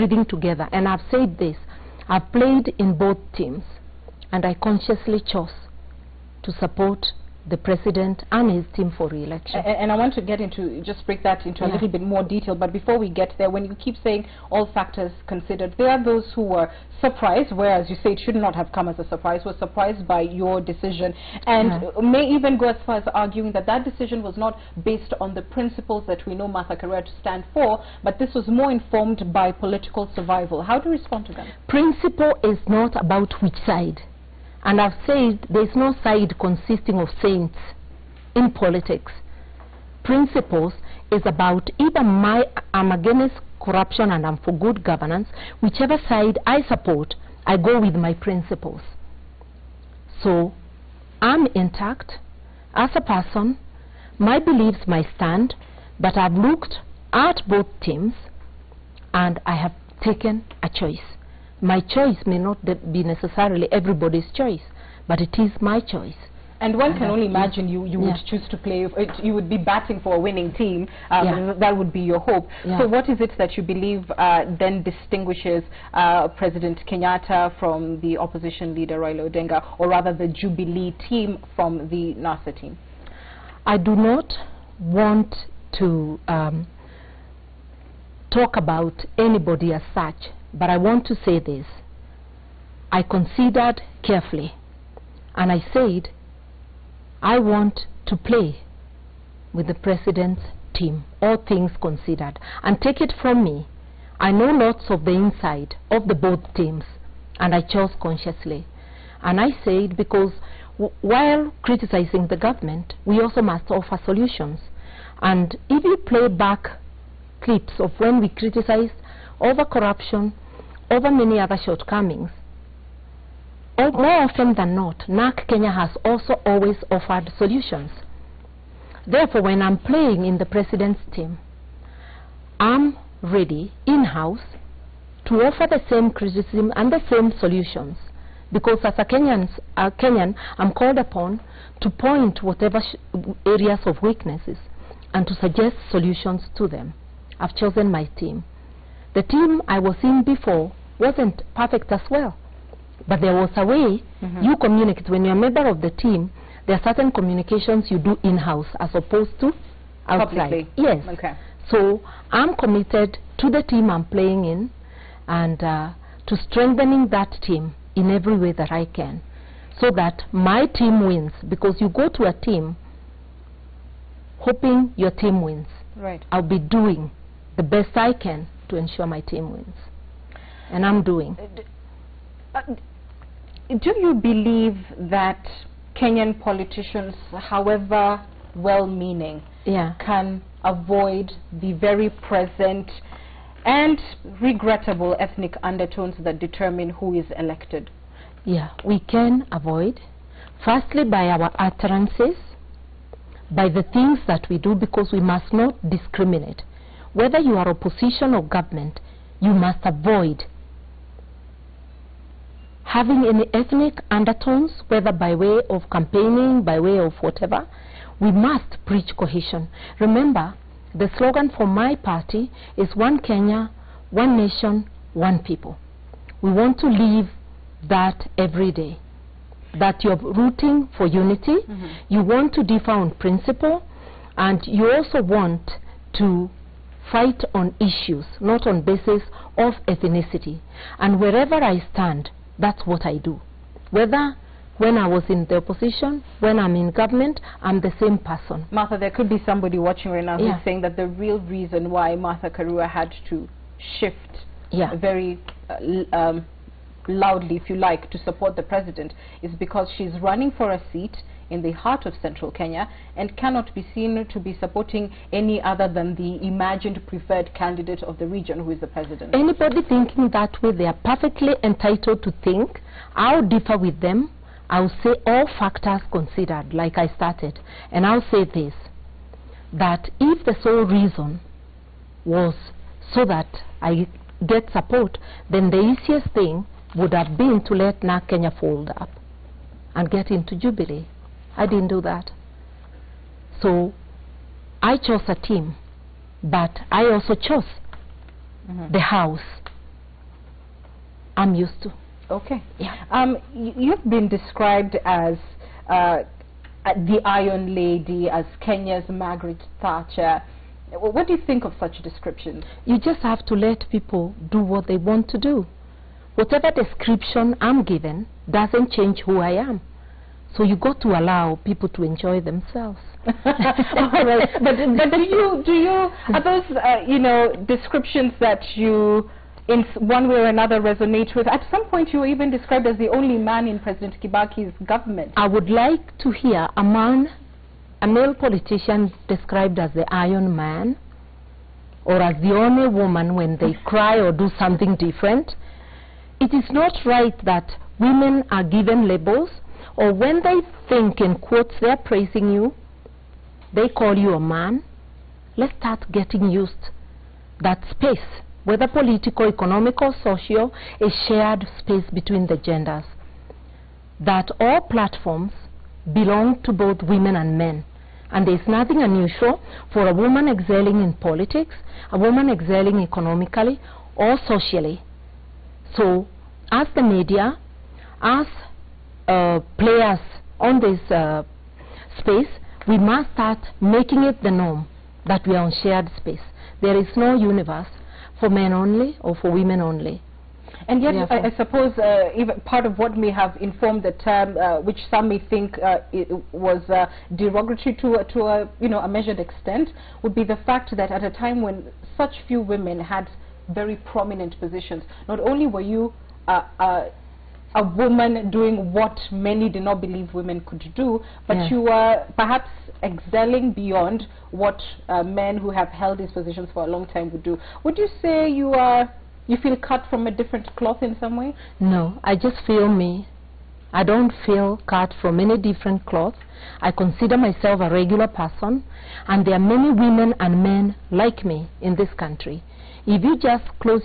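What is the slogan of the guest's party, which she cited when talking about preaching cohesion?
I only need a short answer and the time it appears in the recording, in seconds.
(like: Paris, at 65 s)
One Kenya, One Nation, One People, at 222 s.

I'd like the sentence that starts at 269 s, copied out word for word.
Anybody thinking that way, they are perfectly entitled to think.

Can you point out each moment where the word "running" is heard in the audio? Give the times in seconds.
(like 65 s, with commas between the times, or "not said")
260 s.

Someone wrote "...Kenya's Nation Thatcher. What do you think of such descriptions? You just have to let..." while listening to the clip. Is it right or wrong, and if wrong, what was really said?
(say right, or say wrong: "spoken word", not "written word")
wrong: "Margaret", not "Nation".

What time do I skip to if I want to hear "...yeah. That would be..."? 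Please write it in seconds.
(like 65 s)
71 s.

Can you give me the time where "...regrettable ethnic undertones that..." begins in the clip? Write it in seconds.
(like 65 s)
194 s.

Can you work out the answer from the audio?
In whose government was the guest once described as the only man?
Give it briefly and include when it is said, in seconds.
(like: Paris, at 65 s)
President Kibaki's, at 333 s.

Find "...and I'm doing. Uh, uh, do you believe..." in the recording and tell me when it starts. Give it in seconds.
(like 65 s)
180 s.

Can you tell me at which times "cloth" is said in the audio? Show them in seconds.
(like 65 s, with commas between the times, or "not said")
420 s, 426 s.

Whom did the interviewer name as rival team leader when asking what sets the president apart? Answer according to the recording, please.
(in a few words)
Raila Odinga.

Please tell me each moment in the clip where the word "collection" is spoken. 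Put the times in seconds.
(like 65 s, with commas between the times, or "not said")
not said.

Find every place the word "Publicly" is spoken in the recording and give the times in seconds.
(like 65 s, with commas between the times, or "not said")
160 s.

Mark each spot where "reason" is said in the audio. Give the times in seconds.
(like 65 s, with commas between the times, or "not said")
251 s, 280 s.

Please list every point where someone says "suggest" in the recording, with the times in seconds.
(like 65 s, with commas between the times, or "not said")
145 s.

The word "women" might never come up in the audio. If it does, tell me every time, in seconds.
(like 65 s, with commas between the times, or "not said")
347 s, 367 s, 389 s, 402 s, 410 s, 429 s.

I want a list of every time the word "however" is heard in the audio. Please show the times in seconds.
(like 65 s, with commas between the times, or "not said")
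187 s.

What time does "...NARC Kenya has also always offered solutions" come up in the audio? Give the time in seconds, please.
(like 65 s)
125 s.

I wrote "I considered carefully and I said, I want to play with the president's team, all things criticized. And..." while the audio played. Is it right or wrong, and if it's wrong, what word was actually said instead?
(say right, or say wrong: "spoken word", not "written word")
wrong: "considered", not "criticized".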